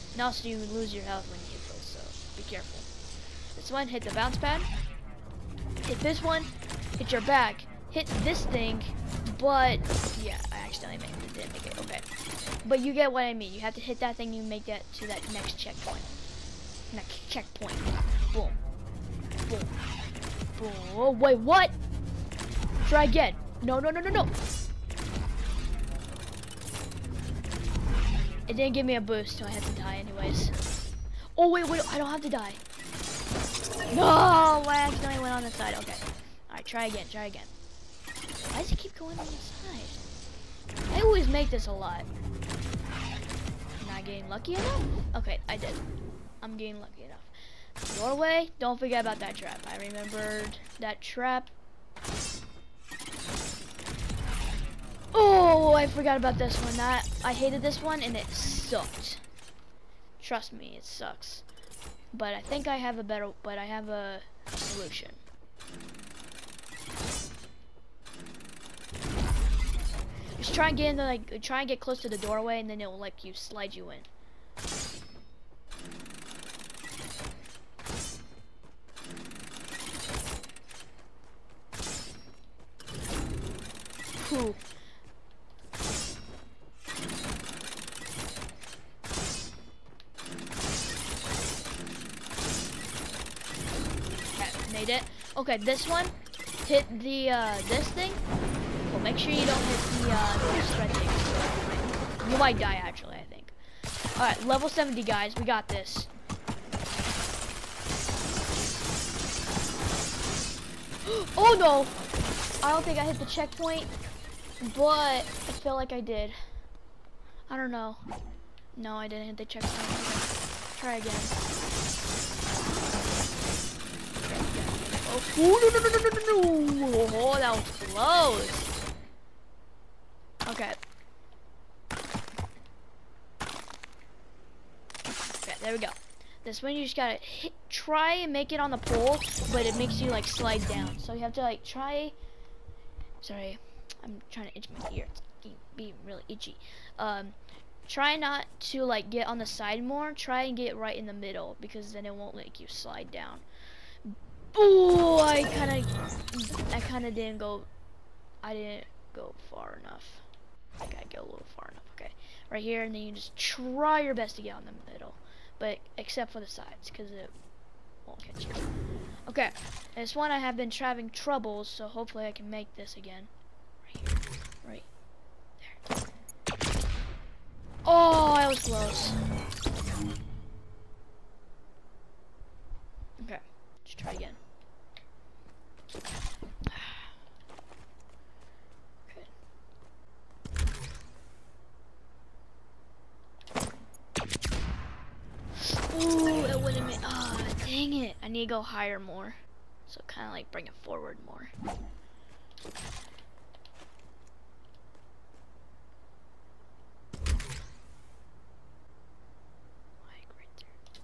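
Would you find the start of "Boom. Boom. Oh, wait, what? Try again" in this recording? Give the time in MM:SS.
00:19.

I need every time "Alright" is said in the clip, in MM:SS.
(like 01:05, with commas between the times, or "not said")
00:36, 01:44.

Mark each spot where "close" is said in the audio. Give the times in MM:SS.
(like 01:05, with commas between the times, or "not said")
01:11, 02:07, 02:58.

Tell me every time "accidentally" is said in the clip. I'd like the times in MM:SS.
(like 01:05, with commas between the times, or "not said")
00:10, 00:34.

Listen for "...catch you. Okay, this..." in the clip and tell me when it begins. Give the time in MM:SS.
02:48.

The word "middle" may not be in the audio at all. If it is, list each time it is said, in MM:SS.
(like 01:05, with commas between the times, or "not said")
02:31, 02:44.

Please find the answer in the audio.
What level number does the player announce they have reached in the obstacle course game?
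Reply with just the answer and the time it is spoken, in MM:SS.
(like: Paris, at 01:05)
70, at 01:44.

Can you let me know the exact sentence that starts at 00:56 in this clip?
That I hated this one and it sucked.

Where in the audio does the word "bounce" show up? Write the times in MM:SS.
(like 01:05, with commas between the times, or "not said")
00:04.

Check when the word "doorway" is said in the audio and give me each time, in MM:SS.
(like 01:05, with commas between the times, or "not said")
00:47, 01:12.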